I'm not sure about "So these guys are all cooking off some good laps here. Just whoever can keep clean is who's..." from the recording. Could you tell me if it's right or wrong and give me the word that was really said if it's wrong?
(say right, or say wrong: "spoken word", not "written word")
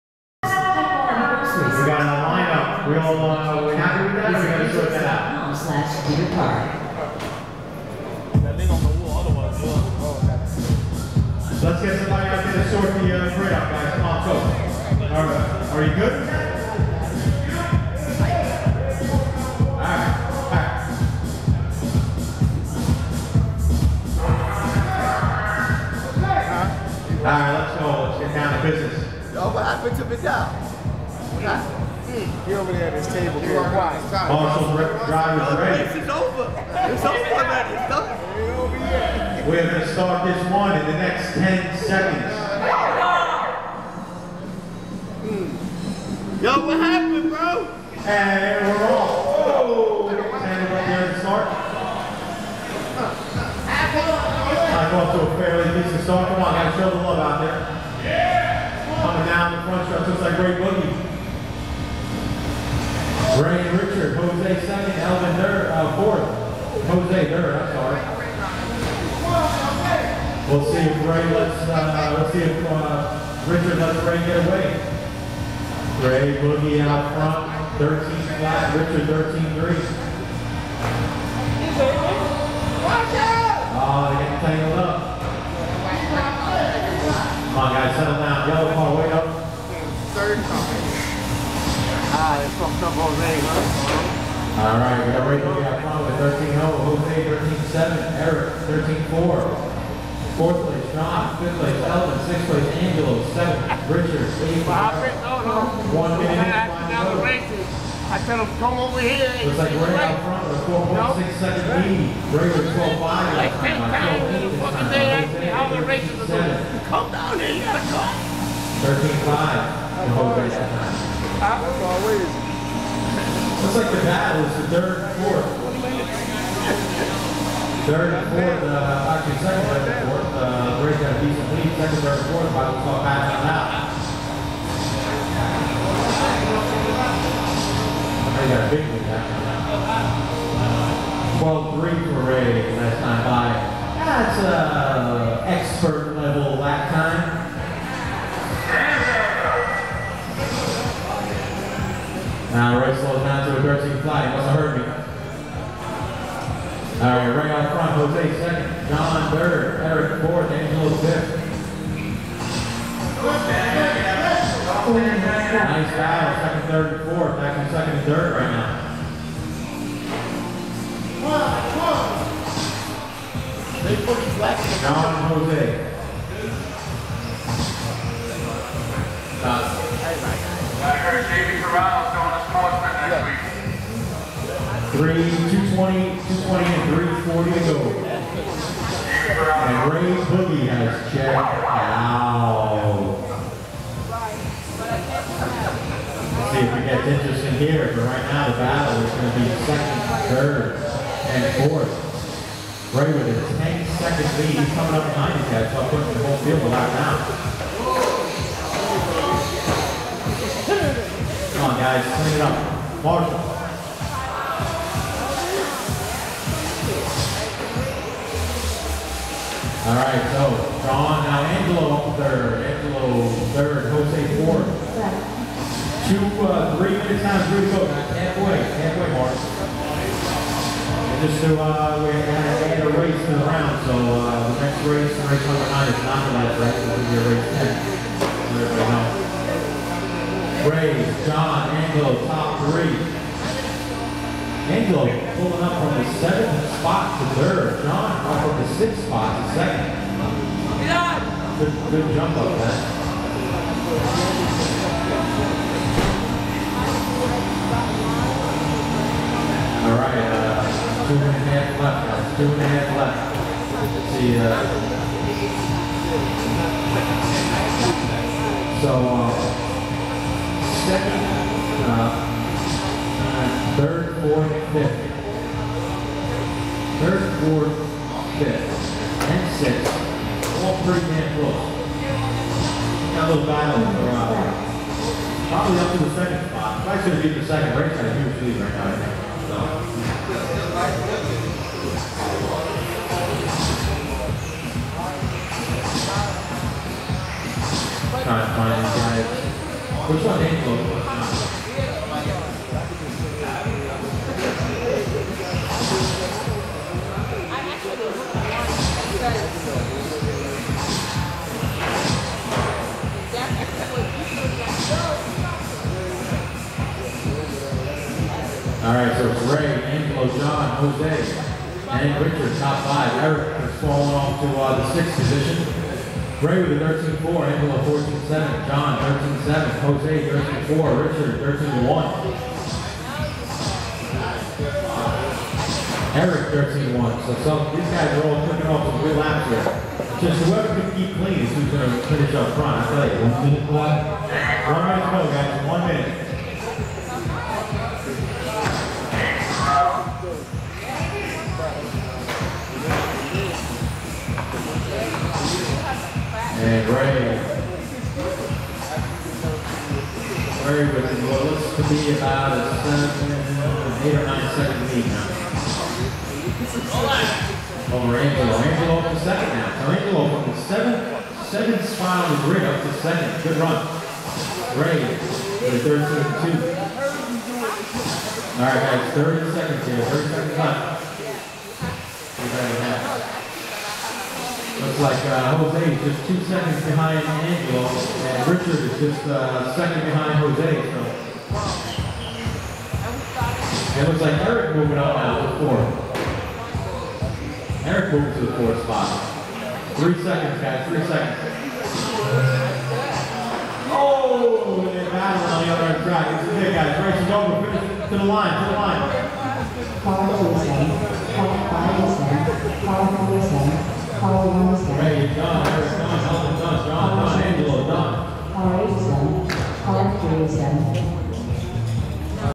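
right.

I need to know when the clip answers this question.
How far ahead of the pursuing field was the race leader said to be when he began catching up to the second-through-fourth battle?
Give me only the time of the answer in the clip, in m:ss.
3:23.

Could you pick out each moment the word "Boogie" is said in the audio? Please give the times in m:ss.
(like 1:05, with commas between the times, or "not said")
1:00, 1:16, 1:35, 3:10.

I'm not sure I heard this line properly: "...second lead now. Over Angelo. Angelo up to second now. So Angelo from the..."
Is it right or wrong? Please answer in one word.
right.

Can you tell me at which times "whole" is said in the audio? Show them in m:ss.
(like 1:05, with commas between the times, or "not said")
3:26.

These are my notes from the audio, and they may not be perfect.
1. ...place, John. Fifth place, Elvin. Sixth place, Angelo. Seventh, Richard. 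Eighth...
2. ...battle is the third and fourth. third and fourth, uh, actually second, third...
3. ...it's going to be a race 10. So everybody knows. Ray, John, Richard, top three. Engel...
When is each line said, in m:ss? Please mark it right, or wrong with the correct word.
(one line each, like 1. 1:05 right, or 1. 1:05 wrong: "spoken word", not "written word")
1. 1:40 right
2. 2:04 right
3. 3:56 wrong: "Angelo", not "Richard".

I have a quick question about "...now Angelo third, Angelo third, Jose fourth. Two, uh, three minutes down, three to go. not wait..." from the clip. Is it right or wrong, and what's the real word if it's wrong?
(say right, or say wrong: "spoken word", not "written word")
right.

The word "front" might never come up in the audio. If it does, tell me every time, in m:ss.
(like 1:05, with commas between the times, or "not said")
0:59, 1:17, 1:35, 1:50, 5:42.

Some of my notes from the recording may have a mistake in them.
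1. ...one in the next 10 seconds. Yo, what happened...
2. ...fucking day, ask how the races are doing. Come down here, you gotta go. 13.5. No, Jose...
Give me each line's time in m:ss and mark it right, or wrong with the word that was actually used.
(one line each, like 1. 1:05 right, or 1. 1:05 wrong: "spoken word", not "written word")
1. 0:40 right
2. 1:54 right.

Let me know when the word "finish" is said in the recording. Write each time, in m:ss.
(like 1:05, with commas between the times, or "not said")
5:42, 6:47.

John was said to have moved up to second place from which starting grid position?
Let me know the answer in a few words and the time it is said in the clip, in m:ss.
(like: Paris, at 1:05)
6th, at 4:08.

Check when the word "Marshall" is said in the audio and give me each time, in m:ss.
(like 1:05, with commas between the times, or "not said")
0:34, 3:33.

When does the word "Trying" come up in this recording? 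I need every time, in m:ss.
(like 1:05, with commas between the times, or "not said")
4:58.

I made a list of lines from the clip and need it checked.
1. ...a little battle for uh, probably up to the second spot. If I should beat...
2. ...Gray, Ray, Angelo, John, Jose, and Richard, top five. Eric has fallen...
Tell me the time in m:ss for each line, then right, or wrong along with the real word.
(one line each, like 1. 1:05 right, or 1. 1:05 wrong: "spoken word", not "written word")
1. 4:43 right
2. 5:19 right.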